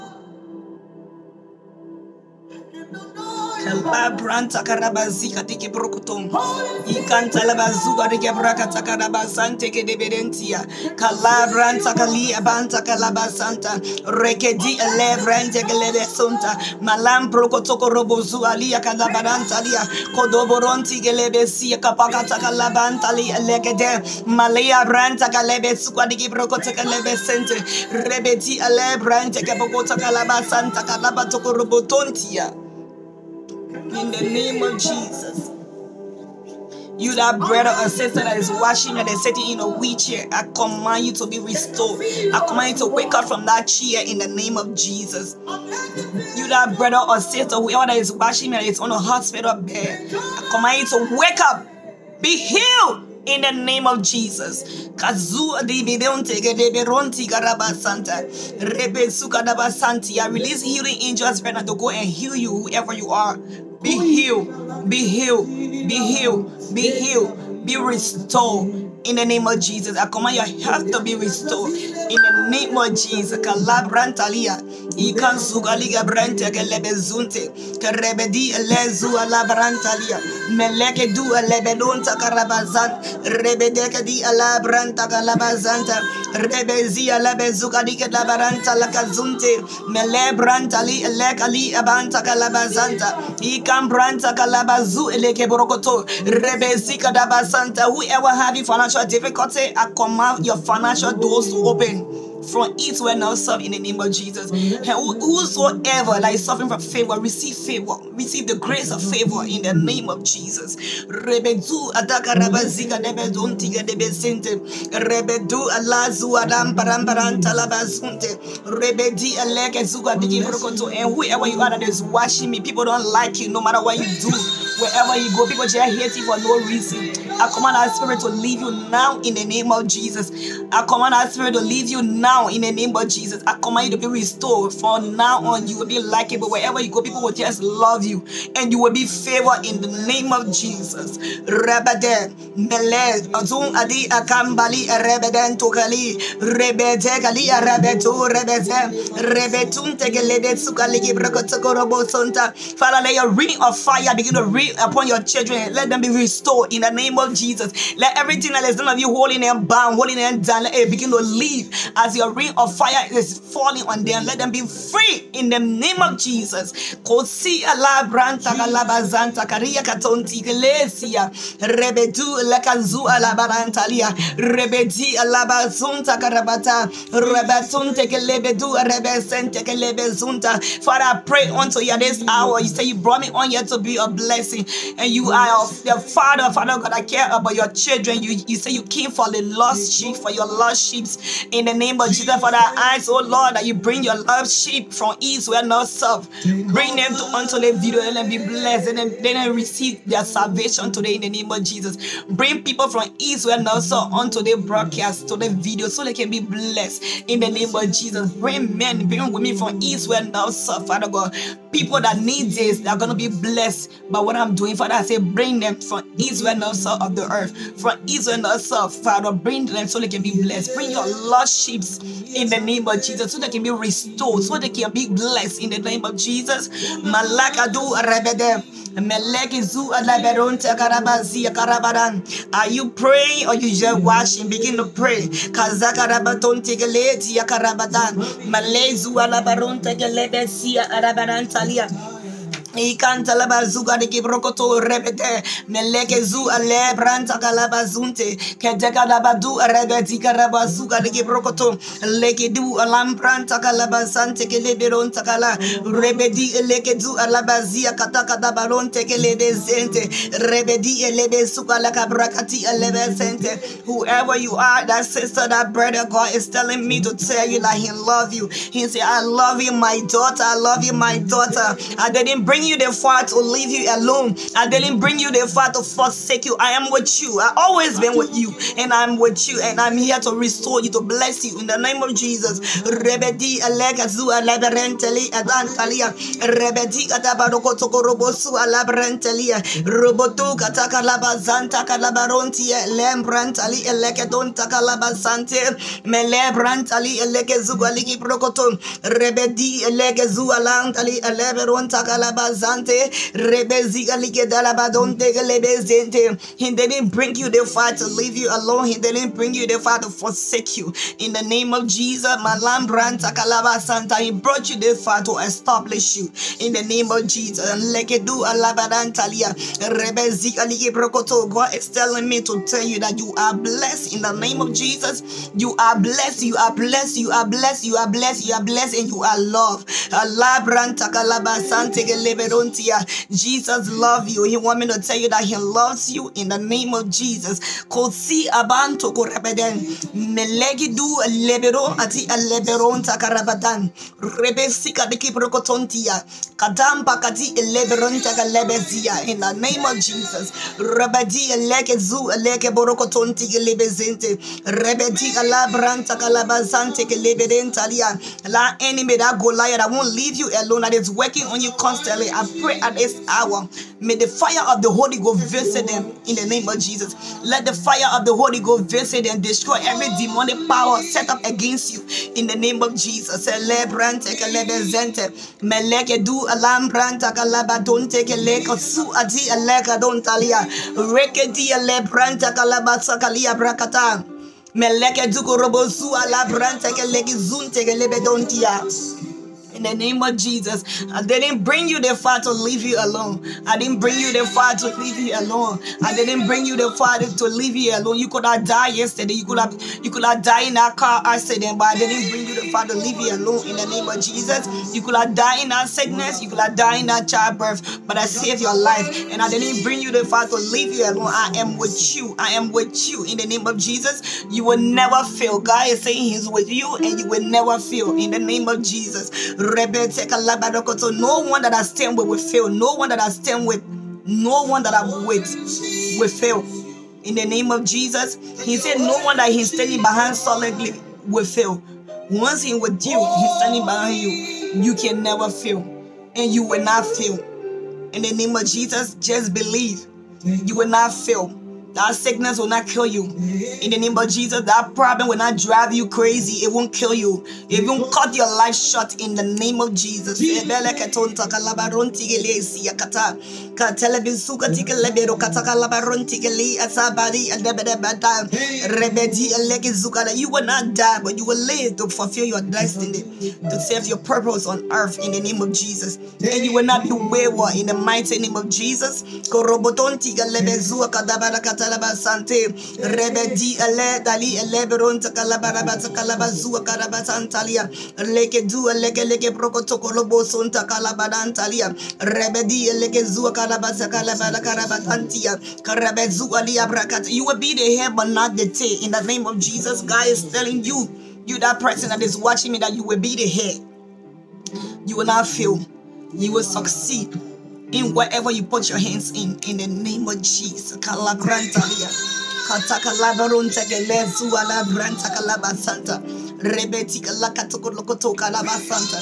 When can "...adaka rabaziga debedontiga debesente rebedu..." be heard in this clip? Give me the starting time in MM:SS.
01:51.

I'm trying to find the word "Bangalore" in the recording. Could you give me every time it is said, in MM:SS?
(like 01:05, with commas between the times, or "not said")
not said.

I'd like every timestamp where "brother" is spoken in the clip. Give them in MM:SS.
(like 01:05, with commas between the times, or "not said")
00:37, 00:46, 04:25.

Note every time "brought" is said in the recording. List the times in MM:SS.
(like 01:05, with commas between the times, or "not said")
03:02, 05:14.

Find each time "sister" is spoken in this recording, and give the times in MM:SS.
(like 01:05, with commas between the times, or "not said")
00:37, 00:47, 04:25.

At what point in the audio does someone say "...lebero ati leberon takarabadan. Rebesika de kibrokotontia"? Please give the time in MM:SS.
05:41.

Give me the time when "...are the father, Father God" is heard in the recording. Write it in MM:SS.
03:05.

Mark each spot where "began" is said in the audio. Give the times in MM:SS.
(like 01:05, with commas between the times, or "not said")
not said.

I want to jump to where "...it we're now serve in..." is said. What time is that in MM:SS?
01:42.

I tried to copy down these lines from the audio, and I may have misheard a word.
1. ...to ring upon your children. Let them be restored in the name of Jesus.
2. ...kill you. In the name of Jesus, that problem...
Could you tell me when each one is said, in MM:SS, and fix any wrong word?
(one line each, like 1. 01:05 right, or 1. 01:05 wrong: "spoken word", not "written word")
1. 02:34 right
2. 07:22 right.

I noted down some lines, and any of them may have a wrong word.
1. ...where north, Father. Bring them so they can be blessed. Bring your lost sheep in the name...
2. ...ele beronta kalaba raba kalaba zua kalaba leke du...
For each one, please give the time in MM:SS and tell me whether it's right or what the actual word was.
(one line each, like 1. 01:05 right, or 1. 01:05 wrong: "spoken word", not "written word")
1. 03:38 right
2. 07:54 right.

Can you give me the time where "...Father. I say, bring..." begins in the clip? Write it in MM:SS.
03:34.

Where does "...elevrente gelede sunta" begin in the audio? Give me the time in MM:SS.
00:14.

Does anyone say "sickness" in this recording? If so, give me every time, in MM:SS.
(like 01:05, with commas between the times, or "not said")
06:45, 07:22.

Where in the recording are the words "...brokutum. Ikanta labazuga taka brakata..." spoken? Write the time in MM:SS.
00:05.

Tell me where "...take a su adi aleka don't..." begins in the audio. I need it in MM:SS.
06:18.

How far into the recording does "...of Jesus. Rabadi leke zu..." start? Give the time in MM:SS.
05:49.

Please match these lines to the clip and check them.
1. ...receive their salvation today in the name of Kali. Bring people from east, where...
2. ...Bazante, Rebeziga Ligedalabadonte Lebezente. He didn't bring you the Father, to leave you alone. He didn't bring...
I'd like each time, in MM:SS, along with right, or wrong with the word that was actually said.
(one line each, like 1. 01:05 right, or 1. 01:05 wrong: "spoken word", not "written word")
1. 03:19 wrong: "Jesus", not "Kali"
2. 05:02 right.